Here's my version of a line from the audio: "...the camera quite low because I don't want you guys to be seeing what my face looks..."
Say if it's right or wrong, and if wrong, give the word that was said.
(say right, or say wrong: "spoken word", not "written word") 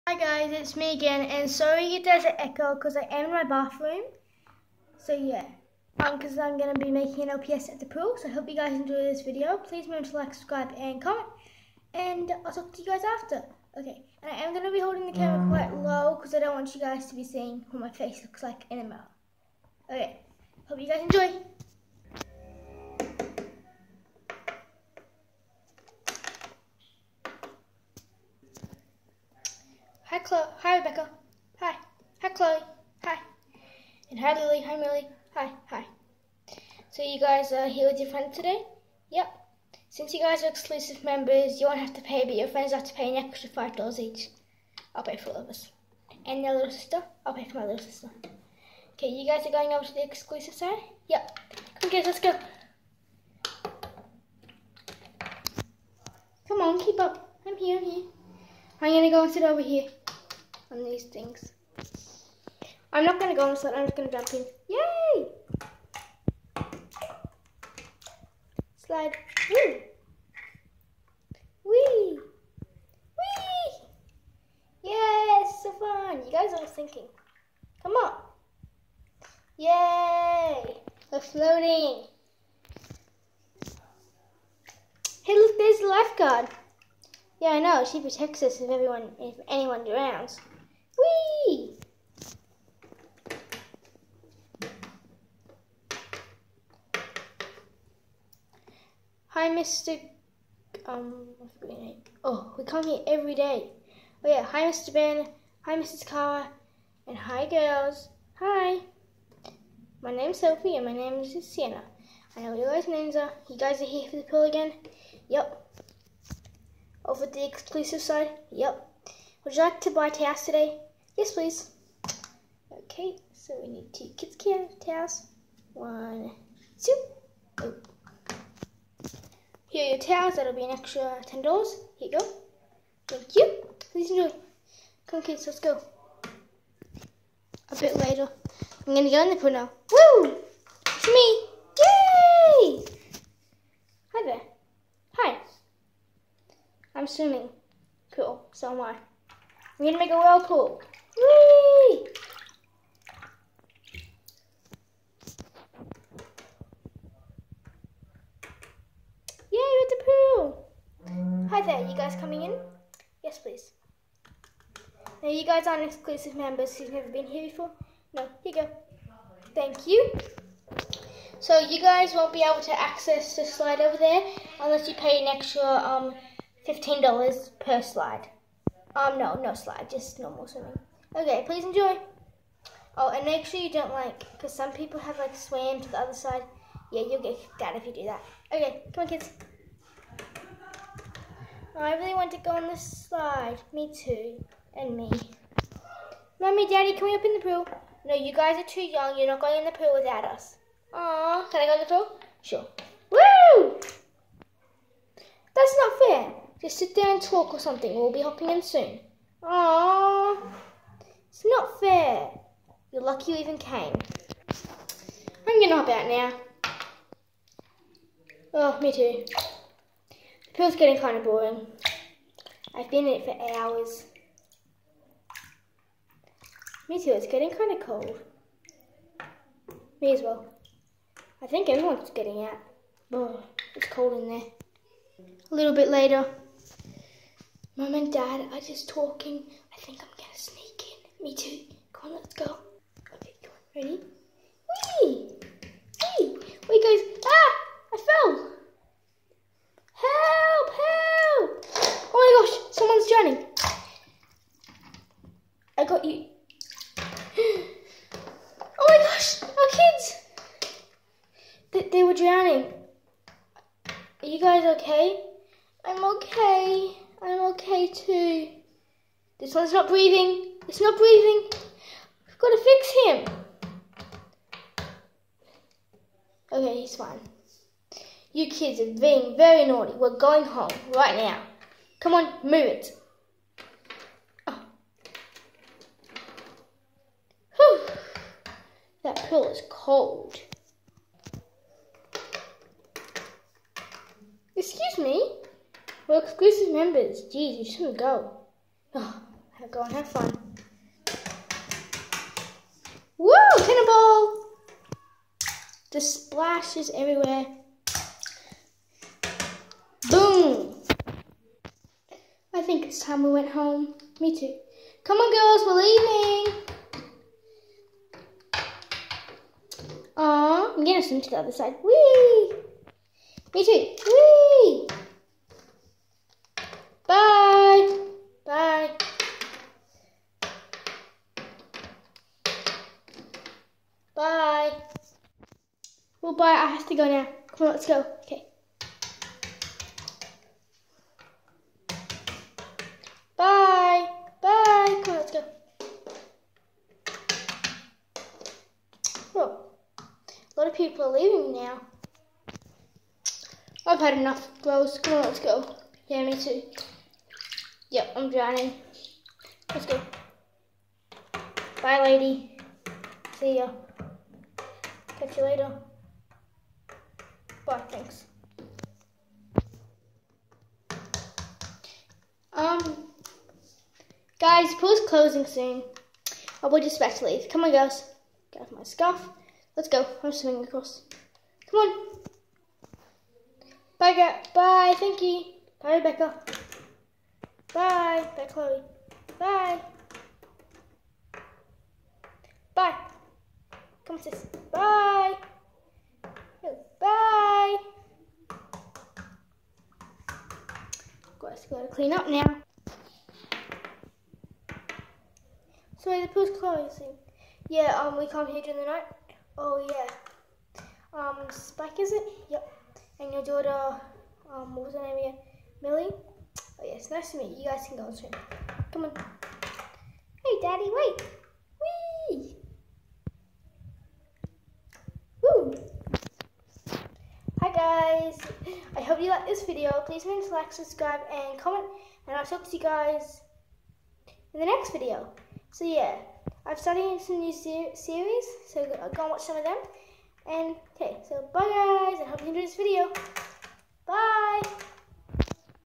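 right.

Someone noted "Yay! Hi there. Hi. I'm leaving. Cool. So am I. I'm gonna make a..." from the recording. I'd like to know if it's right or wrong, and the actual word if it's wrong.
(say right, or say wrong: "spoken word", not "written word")
wrong: "swimming", not "leaving".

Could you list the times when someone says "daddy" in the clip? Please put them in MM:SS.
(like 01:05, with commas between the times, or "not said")
03:16, 07:00.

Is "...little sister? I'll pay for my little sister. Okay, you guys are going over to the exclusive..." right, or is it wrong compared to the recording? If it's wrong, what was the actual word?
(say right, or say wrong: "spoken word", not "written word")
right.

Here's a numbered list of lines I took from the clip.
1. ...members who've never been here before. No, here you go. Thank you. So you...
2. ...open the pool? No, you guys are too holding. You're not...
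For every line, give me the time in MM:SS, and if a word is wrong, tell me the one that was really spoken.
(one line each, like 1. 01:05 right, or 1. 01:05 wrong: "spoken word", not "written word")
1. 02:46 right
2. 03:17 wrong: "young", not "holding".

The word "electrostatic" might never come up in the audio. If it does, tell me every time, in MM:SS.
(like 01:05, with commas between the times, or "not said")
not said.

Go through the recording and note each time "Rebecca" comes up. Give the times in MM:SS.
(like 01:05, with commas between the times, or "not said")
00:30, 06:25.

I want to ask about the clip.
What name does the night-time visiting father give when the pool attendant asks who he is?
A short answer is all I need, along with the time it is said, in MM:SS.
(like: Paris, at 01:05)
Spike, at 06:51.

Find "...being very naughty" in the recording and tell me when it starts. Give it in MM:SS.
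04:39.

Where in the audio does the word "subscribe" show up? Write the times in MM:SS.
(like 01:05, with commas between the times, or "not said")
00:10, 07:10.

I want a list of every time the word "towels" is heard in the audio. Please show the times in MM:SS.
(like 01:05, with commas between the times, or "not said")
02:00, 02:04, 02:09.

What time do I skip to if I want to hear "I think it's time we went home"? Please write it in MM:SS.
05:12.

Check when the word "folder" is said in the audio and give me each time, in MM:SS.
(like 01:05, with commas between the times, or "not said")
not said.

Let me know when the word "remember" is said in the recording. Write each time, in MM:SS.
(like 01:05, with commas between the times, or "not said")
00:09, 07:10.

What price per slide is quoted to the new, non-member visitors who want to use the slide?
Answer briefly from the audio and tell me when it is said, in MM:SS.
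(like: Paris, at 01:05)
$15, at 02:56.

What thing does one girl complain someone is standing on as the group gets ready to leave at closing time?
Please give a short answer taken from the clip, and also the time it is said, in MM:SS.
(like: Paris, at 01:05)
My scarf, at 06:18.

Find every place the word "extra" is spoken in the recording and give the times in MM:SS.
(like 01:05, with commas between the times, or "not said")
00:43, 02:10, 02:55.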